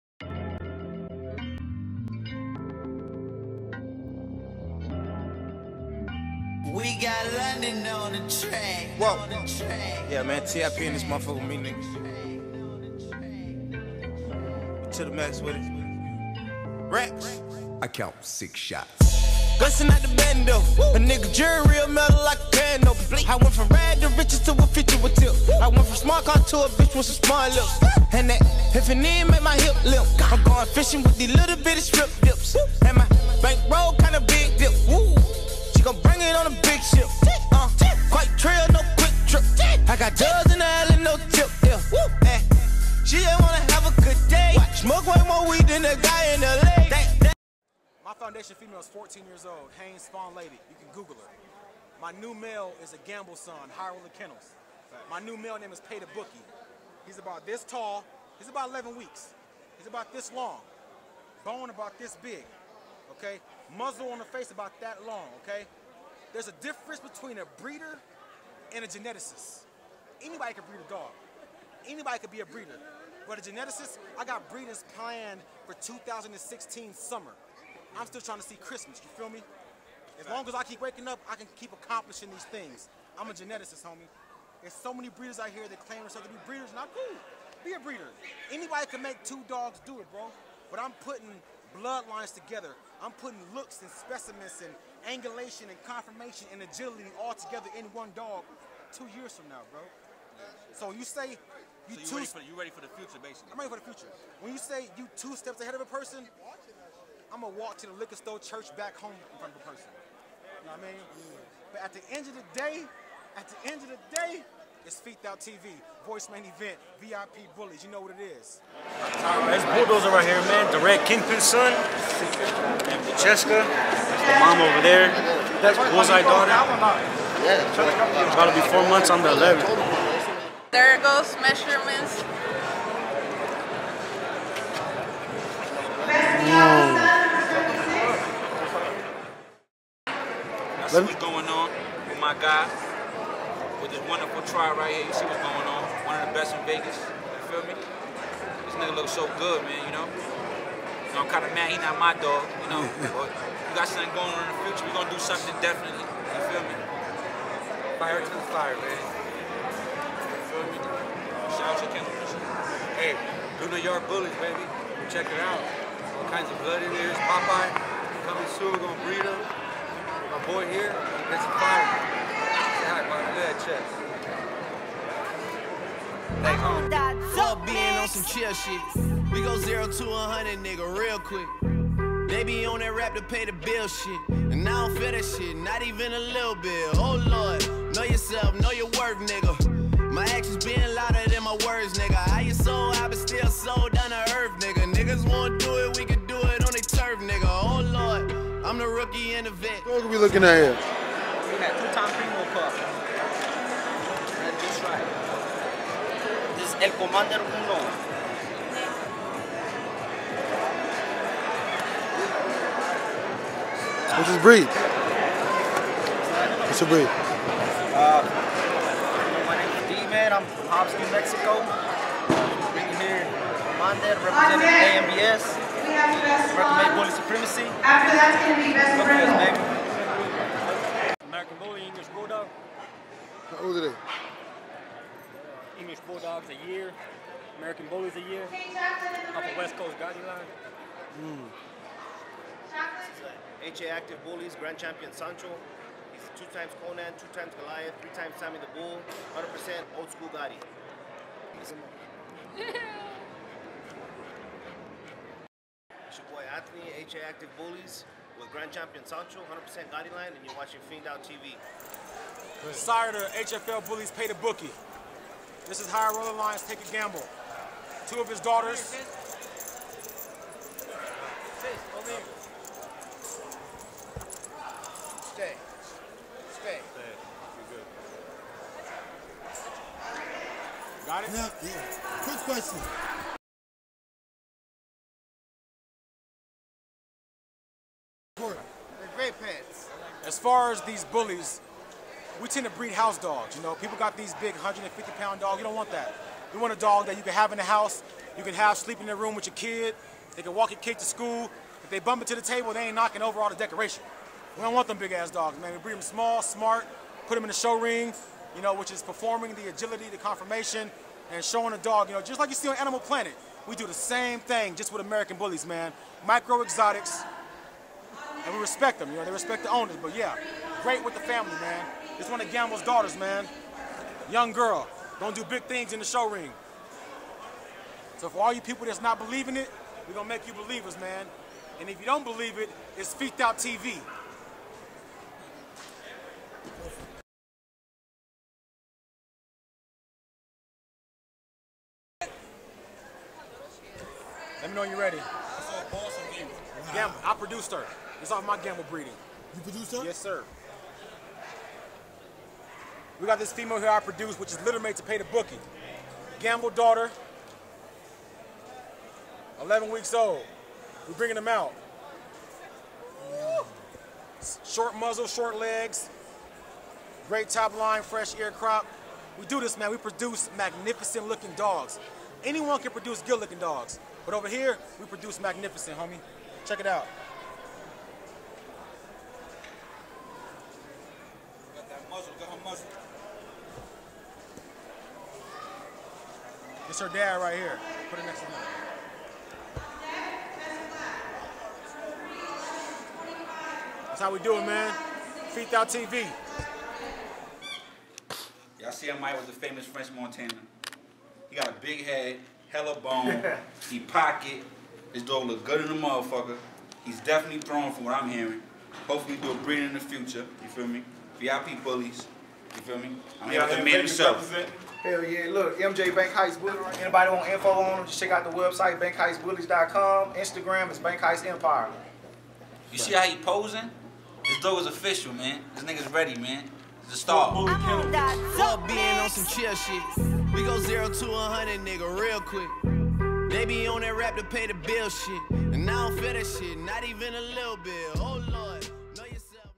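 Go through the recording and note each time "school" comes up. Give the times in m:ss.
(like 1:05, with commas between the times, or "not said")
4:10, 5:01.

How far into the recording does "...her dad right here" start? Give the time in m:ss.
6:26.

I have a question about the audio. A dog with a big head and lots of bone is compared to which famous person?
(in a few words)
French Montana.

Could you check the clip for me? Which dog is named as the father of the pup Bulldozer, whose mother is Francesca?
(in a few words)
The Red Kingpin.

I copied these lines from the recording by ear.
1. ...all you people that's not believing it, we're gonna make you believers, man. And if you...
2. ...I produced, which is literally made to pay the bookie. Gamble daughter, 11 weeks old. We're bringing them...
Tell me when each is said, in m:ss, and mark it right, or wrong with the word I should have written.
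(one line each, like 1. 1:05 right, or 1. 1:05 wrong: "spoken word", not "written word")
1. 5:28 right
2. 5:53 right.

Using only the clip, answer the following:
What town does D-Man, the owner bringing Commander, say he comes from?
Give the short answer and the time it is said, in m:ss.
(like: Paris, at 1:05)
Hobbs, New Mexico, at 3:40.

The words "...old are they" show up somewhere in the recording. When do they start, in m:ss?
3:53.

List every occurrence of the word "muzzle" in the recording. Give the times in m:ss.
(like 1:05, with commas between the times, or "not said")
1:03, 6:04.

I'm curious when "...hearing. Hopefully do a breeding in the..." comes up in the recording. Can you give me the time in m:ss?
6:48.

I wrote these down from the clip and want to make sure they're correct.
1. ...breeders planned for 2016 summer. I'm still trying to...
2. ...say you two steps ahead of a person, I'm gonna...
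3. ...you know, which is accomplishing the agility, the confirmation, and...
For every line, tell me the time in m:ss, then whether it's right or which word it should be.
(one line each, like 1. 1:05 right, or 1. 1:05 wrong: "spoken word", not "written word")
1. 1:14 right
2. 1:44 right
3. 5:08 wrong: "performing", not "accomplishing".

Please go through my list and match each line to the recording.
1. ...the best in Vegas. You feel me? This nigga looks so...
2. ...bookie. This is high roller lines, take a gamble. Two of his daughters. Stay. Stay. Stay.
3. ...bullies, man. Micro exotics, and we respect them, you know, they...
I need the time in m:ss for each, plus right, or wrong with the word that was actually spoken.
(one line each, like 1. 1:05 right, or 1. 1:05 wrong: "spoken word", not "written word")
1. 2:26 right
2. 4:24 right
3. 5:15 right.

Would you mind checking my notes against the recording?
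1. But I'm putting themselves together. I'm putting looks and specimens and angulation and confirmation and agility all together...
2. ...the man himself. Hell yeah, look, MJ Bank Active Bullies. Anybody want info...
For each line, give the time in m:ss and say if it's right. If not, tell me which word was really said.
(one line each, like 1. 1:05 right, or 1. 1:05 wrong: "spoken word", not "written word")
1. 1:30 wrong: "bloodlines", not "themselves"
2. 6:53 wrong: "Heights", not "Active".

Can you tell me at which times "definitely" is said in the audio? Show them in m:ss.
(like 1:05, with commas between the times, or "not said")
2:35, 6:47.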